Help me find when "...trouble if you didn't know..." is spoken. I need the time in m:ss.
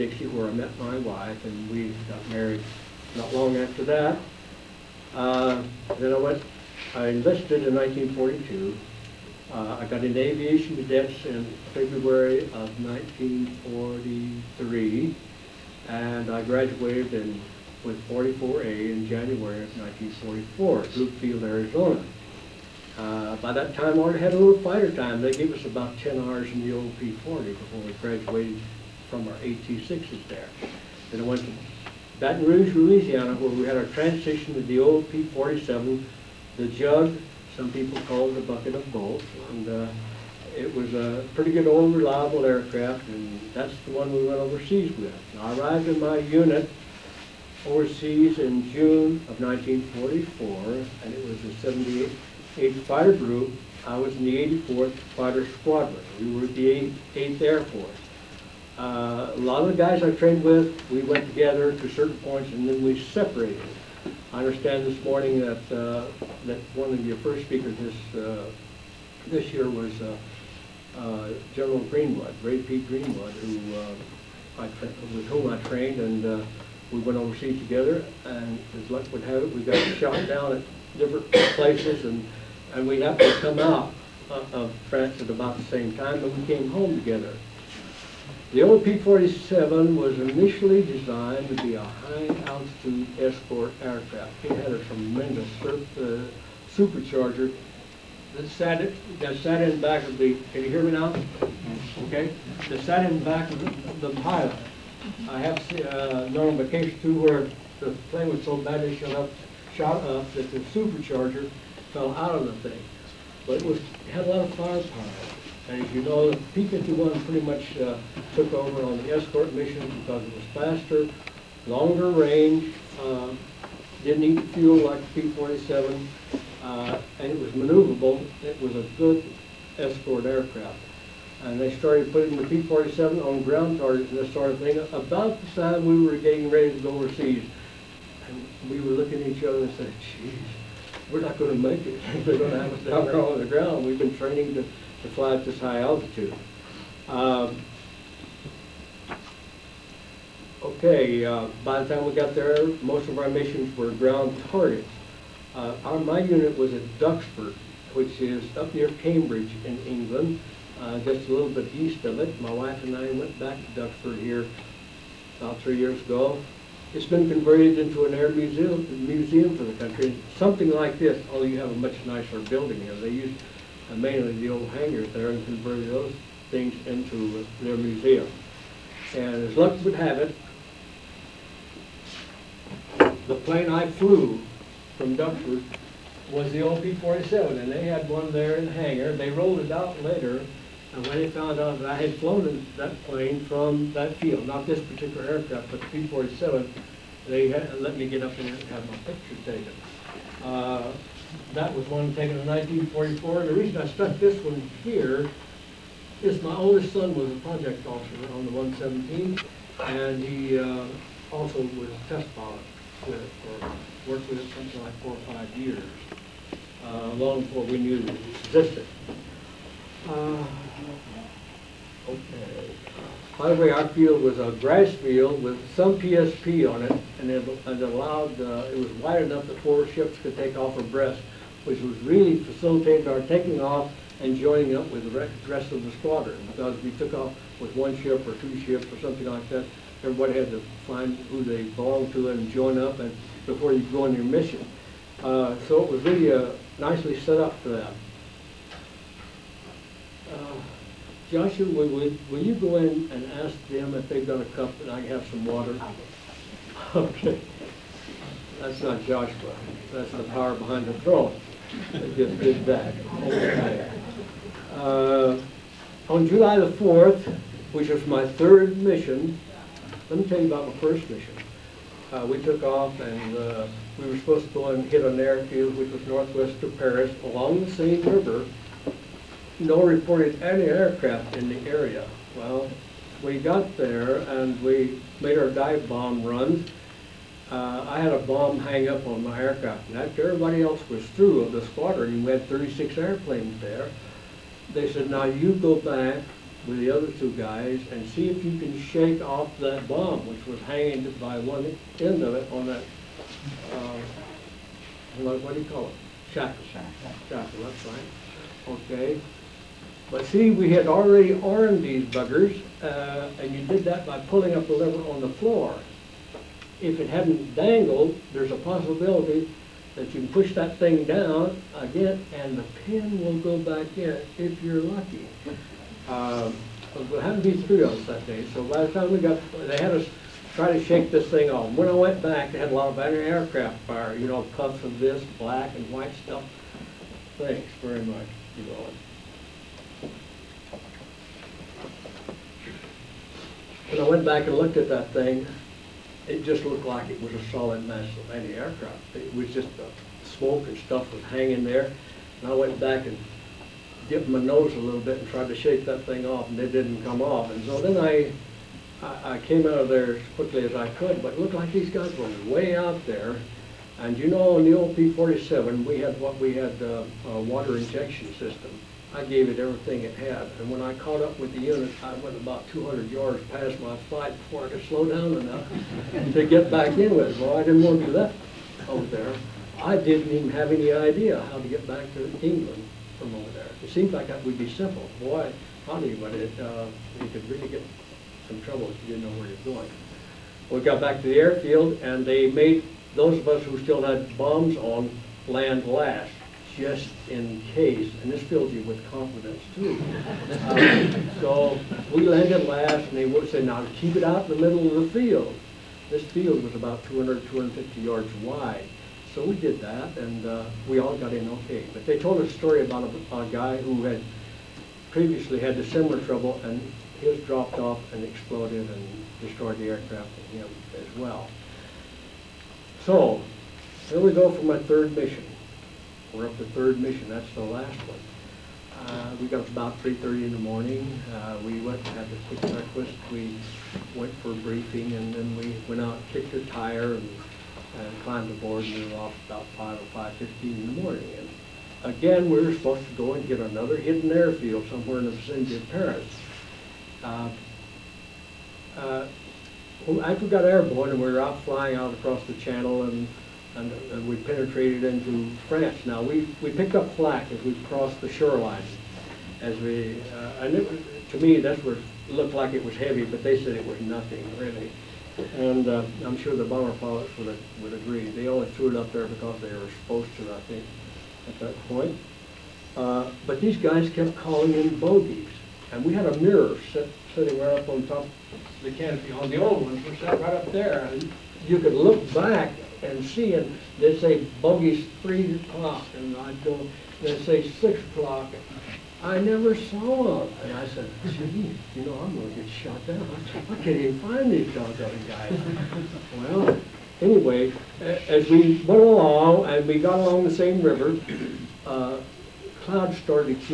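6:28.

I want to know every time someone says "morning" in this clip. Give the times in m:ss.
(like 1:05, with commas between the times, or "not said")
1:05, 7:10, 7:21.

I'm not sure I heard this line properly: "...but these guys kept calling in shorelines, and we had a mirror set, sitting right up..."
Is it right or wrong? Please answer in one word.
wrong.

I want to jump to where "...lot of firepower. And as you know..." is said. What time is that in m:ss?
1:54.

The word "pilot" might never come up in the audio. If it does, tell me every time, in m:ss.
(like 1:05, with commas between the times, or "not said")
1:44, 3:32, 7:46.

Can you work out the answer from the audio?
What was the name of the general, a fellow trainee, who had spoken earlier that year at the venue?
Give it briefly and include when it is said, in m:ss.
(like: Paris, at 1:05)
Ray Pete Greenwood, at 1:12.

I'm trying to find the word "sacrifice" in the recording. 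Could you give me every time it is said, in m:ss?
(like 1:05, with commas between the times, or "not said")
not said.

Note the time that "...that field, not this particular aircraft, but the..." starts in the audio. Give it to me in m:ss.
3:13.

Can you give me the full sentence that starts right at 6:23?
It seems like that would be simple.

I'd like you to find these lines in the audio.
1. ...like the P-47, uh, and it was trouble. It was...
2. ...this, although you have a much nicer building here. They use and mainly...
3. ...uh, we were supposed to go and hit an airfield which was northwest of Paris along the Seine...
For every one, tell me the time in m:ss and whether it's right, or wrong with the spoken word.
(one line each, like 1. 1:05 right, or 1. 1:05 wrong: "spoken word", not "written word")
1. 2:04 wrong: "maneuverable", not "trouble"
2. 2:50 right
3. 4:33 right.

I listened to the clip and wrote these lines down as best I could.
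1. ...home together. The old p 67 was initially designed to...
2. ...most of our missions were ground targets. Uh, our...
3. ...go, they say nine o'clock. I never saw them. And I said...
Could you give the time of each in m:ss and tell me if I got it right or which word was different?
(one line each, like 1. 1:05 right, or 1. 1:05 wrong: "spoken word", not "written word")
1. 1:26 wrong: "47", not "67"
2. 2:32 right
3. 8:06 wrong: "six", not "nine".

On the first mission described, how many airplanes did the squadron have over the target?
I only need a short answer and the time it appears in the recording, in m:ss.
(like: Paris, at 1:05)
36, at 4:52.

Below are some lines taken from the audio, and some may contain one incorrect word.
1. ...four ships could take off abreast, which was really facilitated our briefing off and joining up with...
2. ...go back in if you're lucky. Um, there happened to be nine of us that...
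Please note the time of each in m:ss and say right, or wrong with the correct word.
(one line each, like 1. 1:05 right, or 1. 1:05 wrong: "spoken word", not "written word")
1. 3:49 wrong: "taking", not "briefing"
2. 5:23 wrong: "three", not "nine".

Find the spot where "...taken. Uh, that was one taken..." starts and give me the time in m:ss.
3:19.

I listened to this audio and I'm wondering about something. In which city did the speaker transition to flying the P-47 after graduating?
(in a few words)
Baton Rouge, Louisiana.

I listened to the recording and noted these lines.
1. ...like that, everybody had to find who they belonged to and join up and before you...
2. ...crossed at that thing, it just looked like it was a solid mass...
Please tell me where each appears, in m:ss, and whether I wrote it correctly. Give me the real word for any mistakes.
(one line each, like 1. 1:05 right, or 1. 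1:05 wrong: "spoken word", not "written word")
1. 3:59 right
2. 5:44 wrong: "looked", not "crossed".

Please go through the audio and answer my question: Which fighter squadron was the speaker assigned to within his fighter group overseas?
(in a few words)
84th Fighter Squadron.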